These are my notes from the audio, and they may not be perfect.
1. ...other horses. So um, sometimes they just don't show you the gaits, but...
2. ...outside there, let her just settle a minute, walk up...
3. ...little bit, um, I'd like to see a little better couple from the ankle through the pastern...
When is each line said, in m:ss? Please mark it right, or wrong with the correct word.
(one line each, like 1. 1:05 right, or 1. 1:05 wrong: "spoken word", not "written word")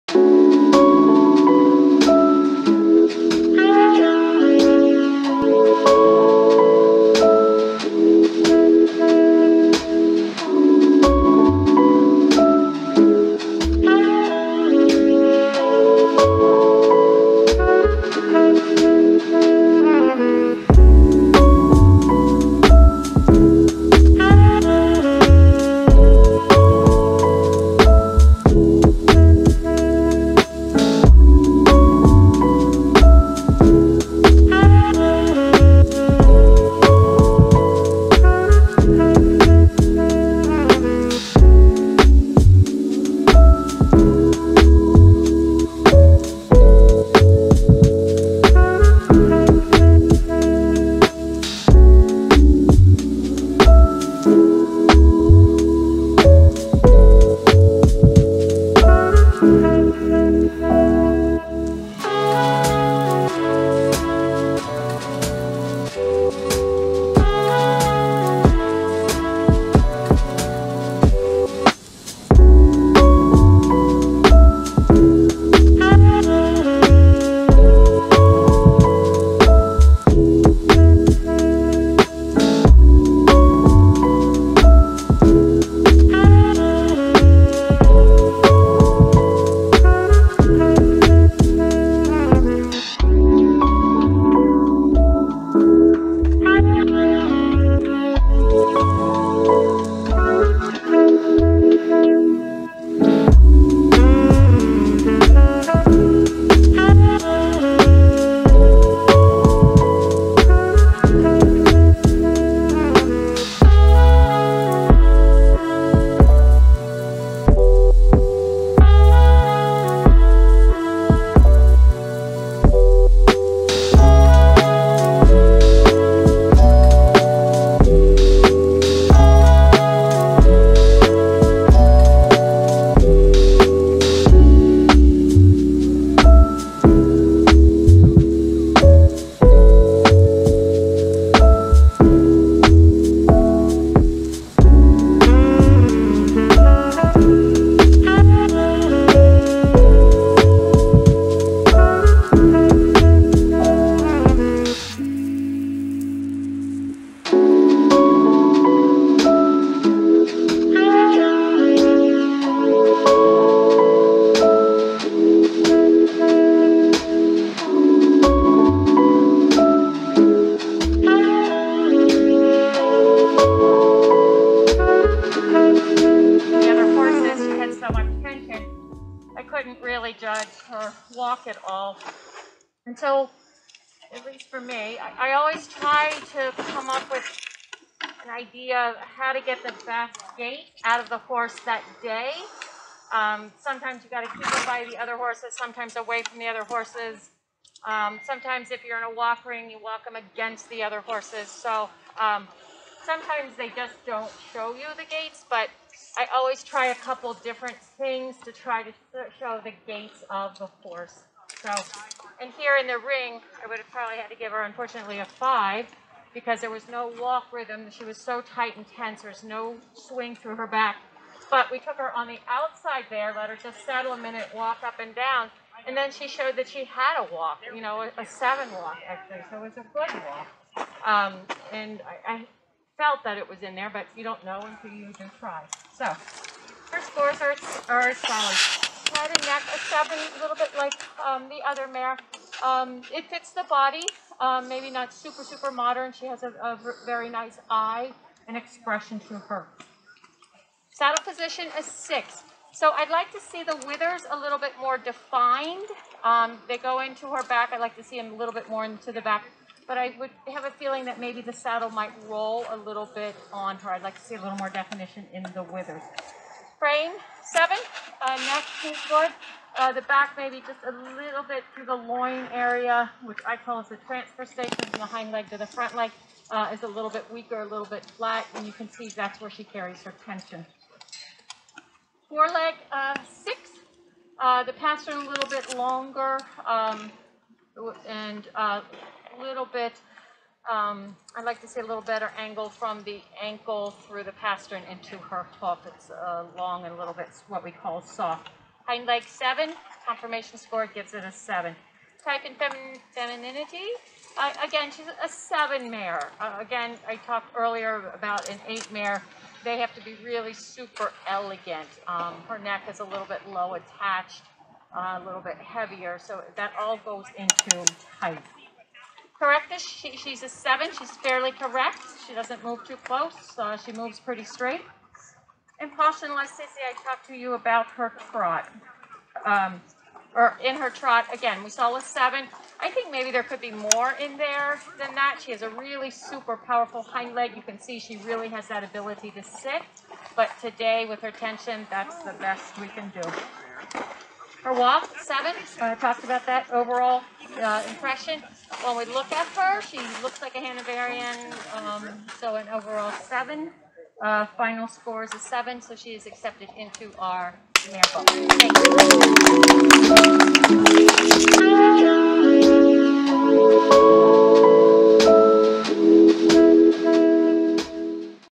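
1. 3:20 right
2. 3:42 right
3. 4:49 wrong: "angle", not "couple".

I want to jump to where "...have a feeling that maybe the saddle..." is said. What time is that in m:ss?
4:20.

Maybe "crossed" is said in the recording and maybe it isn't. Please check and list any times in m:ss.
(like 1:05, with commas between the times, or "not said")
not said.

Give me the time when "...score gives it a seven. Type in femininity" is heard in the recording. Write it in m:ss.
5:00.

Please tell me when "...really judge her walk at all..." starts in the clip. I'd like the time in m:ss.
2:59.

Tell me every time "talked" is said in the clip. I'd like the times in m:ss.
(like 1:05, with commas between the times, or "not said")
5:07, 5:27, 5:45.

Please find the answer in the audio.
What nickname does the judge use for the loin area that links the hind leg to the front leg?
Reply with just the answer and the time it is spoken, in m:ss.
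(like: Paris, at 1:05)
transfer station, at 4:33.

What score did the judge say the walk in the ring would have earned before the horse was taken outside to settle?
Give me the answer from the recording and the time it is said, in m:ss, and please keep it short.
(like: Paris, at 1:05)
5, at 3:35.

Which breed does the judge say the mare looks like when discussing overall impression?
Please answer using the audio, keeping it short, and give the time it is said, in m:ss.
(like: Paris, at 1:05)
Hanoverian, at 5:50.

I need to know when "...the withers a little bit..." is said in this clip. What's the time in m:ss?
4:13.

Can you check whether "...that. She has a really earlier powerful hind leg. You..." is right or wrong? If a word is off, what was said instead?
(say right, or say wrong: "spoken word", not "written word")
wrong: "super", not "earlier".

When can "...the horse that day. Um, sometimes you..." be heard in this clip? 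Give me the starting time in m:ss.
3:11.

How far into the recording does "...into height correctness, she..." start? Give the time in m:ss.
5:17.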